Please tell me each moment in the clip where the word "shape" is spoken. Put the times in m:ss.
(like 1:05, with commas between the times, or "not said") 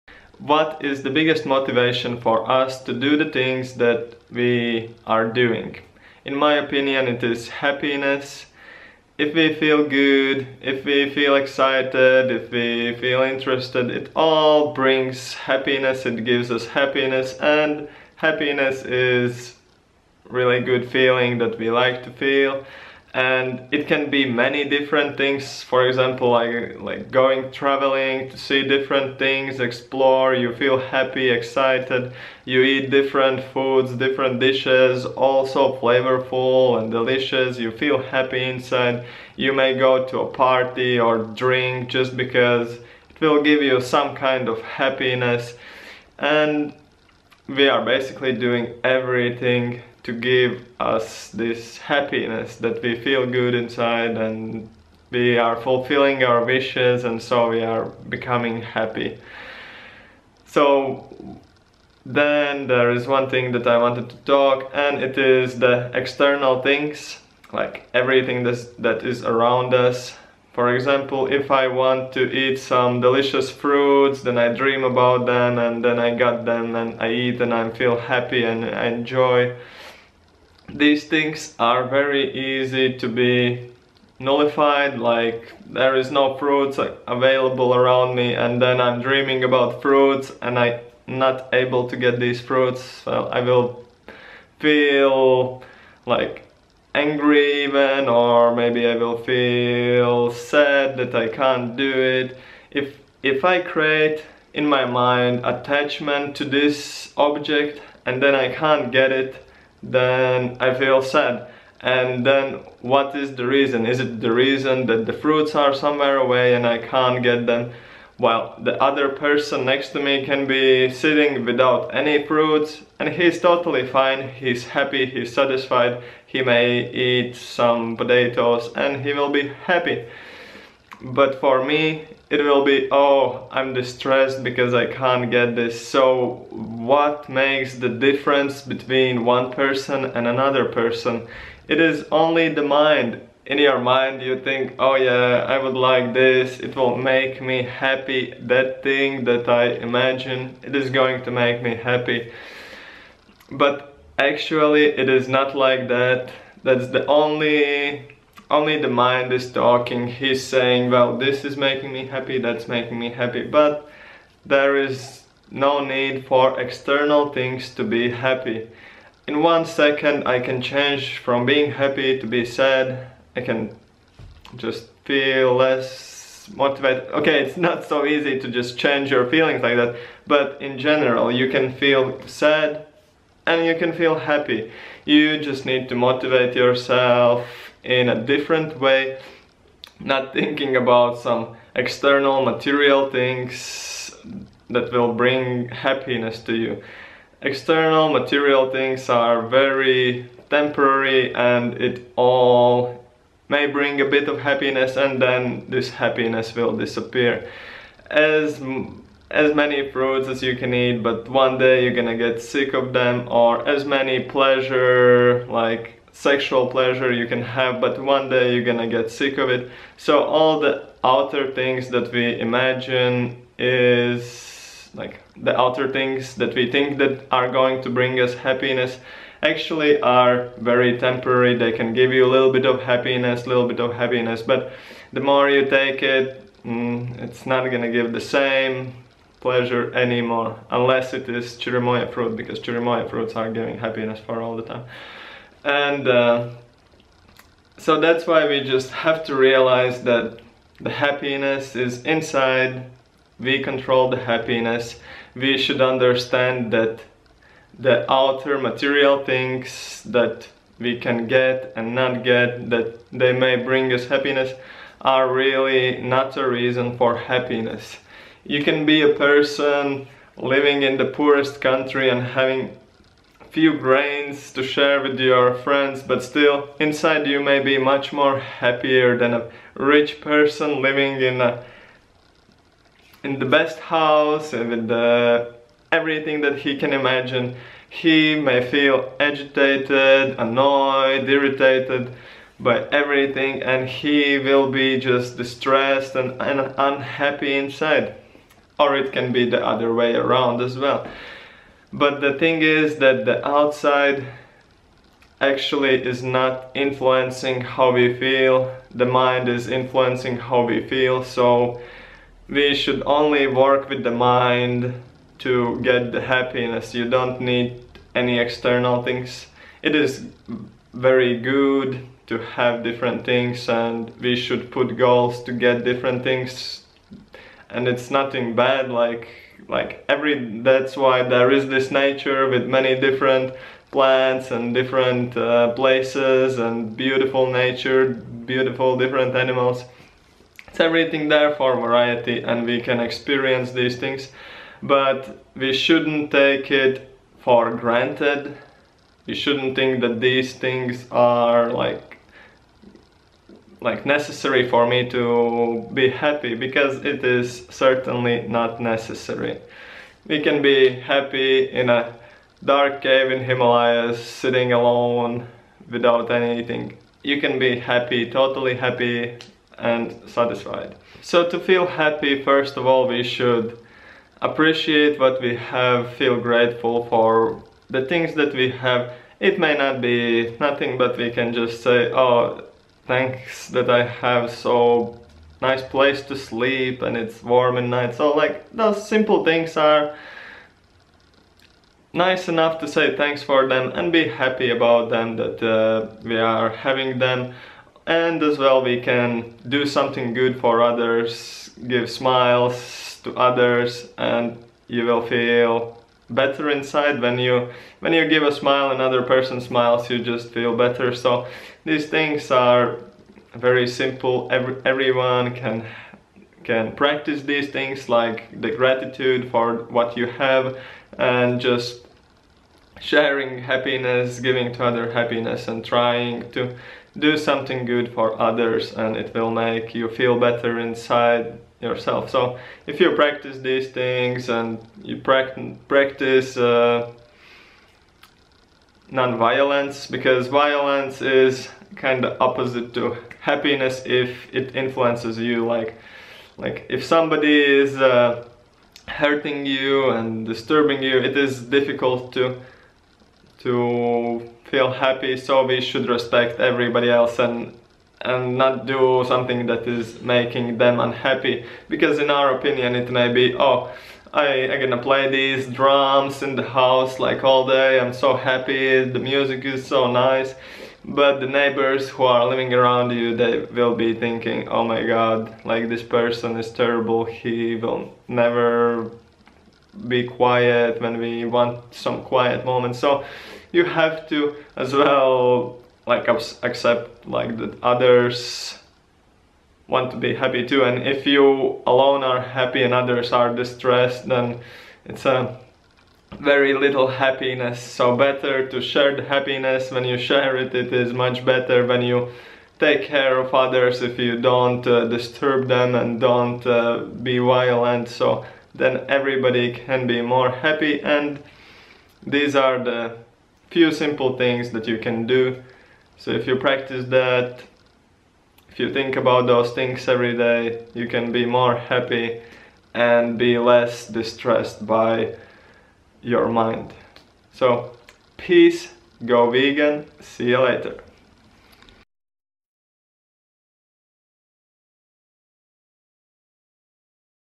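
not said.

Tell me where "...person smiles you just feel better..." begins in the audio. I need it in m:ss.
6:49.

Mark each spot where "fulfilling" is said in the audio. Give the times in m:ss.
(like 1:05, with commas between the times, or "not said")
0:55.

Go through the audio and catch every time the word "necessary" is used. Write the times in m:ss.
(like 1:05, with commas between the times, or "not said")
5:54, 5:58.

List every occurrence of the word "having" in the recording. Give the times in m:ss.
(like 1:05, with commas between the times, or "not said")
4:32, 6:36.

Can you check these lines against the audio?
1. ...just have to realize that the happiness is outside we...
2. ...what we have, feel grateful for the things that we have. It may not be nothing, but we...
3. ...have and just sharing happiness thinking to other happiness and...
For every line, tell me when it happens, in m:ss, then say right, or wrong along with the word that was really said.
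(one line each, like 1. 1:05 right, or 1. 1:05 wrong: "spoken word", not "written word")
1. 4:08 wrong: "inside", not "outside"
2. 6:15 right
3. 7:00 wrong: "giving", not "thinking".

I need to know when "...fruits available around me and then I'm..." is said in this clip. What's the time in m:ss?
1:26.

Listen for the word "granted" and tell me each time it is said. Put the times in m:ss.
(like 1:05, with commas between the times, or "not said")
5:47.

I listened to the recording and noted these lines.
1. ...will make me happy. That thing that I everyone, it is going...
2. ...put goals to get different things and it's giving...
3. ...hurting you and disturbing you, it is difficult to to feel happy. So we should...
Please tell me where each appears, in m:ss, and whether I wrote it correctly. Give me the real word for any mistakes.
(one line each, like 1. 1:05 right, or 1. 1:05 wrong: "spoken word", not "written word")
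1. 2:26 wrong: "imagine", not "everyone"
2. 5:24 wrong: "nothing", not "giving"
3. 7:29 right.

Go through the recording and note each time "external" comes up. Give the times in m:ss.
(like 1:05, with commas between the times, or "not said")
1:05, 2:46, 3:11, 3:17, 5:18.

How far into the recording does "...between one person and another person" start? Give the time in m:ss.
2:18.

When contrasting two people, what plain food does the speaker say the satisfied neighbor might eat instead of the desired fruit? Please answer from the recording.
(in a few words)
Potatoes.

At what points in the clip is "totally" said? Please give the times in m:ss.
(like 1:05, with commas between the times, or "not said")
2:03, 6:08.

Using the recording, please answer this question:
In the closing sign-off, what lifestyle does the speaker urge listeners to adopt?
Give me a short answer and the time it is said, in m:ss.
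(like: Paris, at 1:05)
Go vegan, at 8:49.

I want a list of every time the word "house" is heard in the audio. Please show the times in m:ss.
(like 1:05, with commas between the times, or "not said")
4:43, 7:46.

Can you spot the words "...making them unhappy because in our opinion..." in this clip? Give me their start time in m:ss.
7:40.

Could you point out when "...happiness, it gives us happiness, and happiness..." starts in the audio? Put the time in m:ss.
0:15.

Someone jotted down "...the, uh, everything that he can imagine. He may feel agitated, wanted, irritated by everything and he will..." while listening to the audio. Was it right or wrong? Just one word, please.
wrong.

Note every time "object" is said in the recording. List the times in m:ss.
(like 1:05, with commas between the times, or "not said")
1:47.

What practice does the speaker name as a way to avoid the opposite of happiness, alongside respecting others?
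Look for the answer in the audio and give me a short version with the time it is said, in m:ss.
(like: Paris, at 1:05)
Non-violence, at 7:19.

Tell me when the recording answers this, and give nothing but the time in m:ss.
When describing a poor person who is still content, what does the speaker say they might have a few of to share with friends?
4:33.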